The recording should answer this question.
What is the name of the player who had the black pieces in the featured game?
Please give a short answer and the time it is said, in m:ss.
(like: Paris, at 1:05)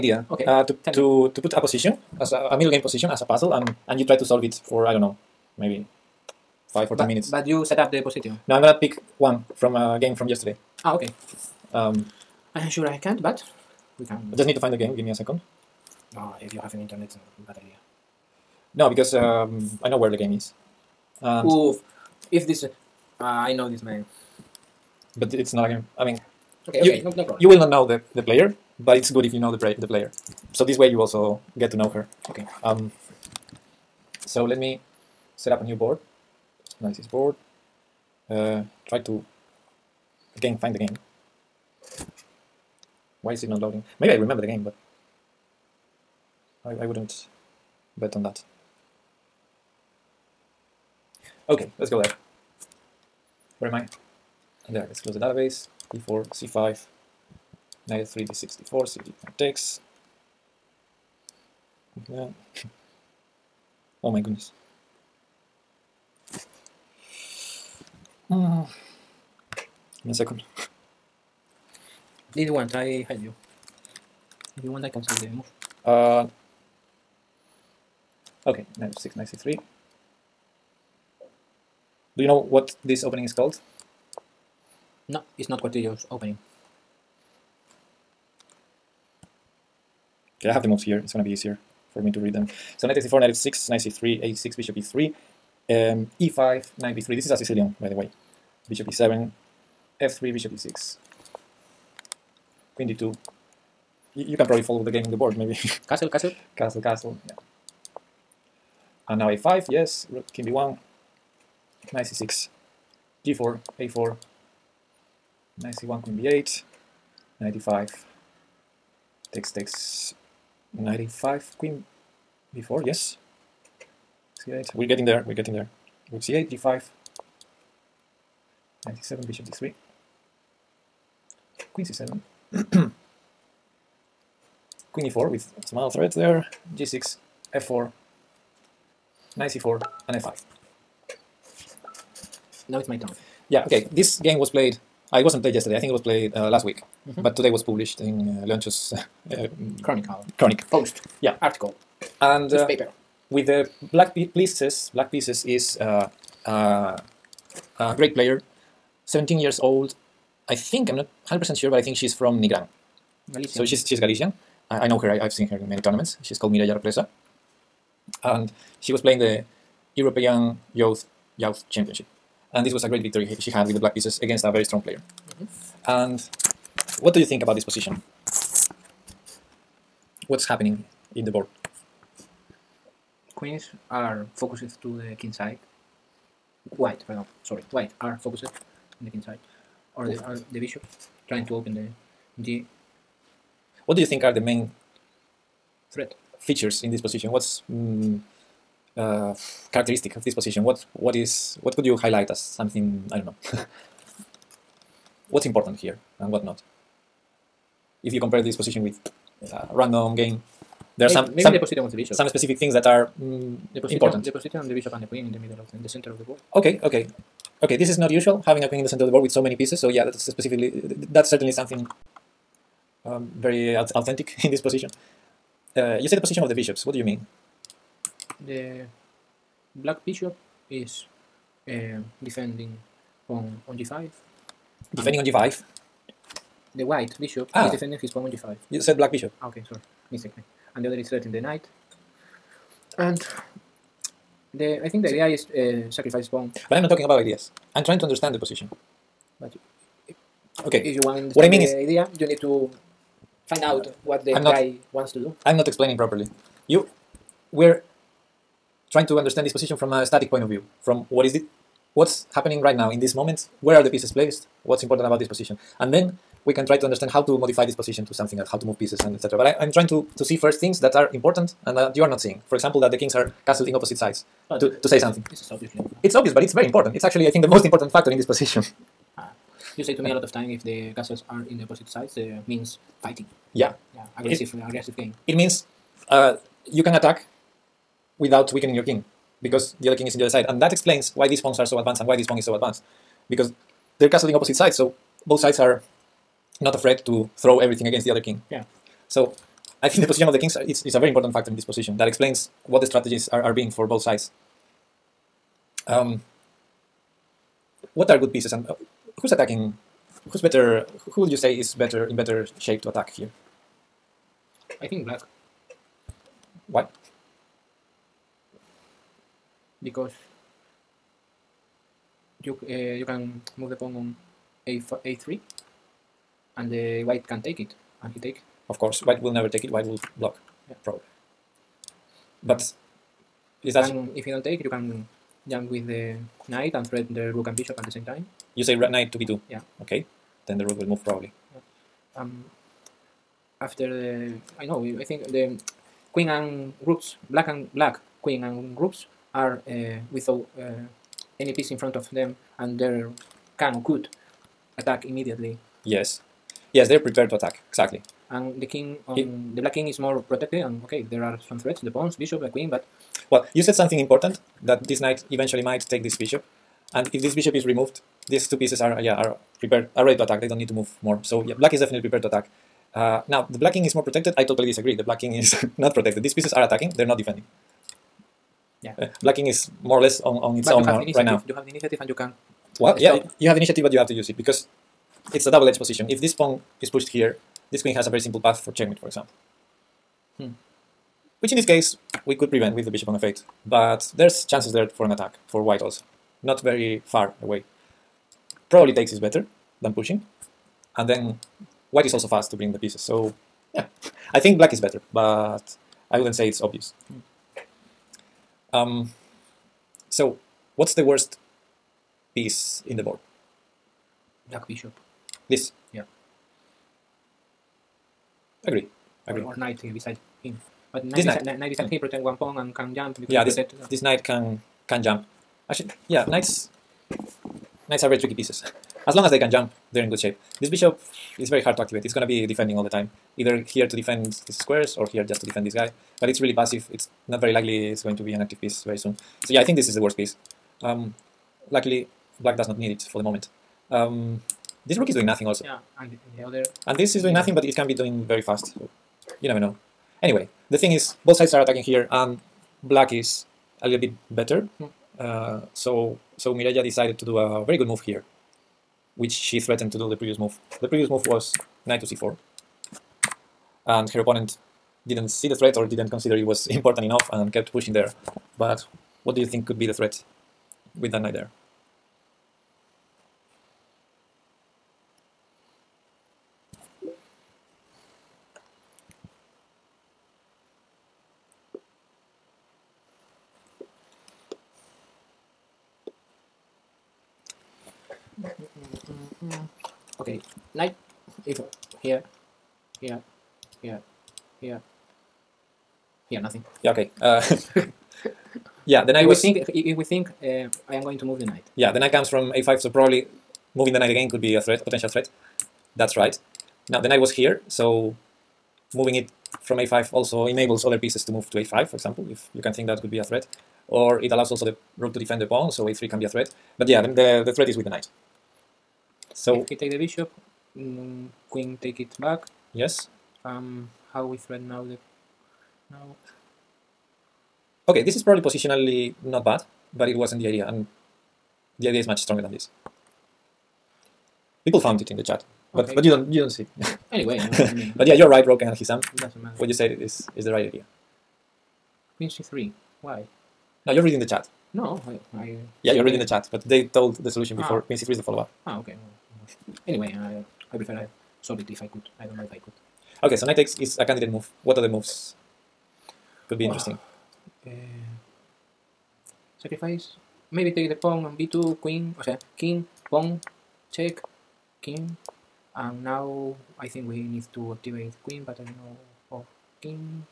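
Mireya Represa, at 2:46.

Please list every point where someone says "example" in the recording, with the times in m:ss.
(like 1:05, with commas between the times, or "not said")
4:32, 6:29, 8:31.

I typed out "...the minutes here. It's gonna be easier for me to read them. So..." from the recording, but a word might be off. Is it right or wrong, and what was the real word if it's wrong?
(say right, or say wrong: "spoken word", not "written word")
wrong: "moves", not "minutes".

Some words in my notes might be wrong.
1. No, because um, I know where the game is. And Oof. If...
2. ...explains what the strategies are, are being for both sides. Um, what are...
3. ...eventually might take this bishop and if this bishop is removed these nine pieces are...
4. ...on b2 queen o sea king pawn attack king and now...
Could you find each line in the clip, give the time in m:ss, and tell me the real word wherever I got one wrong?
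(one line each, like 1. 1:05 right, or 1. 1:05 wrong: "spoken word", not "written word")
1. 0:18 right
2. 5:02 right
3. 6:05 wrong: "two", not "nine"
4. 9:21 wrong: "check", not "attack".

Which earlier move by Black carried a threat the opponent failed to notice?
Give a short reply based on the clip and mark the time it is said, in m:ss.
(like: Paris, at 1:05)
Knight to c4, at 7:41.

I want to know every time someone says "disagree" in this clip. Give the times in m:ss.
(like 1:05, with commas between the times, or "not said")
6:14.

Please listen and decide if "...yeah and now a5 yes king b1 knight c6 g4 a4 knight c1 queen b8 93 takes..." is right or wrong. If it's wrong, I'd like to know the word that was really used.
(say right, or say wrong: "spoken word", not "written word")
wrong: "95", not "93".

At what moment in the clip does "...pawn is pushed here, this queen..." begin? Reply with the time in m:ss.
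6:26.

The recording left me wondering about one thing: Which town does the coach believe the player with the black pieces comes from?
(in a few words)
Nigran.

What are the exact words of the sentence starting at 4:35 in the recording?
This is It's obvious, but it's very important.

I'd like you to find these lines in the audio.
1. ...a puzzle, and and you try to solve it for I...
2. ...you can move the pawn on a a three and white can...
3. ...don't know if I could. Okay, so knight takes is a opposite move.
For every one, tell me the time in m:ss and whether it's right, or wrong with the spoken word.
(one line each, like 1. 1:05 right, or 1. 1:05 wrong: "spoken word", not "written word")
1. 0:03 right
2. 5:22 right
3. 9:12 wrong: "candidate", not "opposite".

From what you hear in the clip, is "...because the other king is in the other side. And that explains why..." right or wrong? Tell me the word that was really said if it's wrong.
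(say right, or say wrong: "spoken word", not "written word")
right.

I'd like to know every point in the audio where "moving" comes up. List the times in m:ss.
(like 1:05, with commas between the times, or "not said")
8:23, 8:28.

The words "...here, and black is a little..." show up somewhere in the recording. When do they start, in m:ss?
7:31.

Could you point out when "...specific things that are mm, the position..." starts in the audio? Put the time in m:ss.
3:32.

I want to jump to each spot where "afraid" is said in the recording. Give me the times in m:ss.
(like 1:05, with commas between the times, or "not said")
4:56.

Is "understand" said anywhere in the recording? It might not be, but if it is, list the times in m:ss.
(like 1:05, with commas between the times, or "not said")
4:08, 4:19, 4:26.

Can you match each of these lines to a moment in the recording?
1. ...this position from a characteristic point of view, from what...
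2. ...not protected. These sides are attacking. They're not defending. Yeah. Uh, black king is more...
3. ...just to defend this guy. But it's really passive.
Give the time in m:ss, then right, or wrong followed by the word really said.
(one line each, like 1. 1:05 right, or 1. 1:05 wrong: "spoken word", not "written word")
1. 4:19 wrong: "static", not "characteristic"
2. 6:15 wrong: "pieces", not "sides"
3. 7:15 right.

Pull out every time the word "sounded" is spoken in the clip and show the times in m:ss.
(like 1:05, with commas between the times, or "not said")
not said.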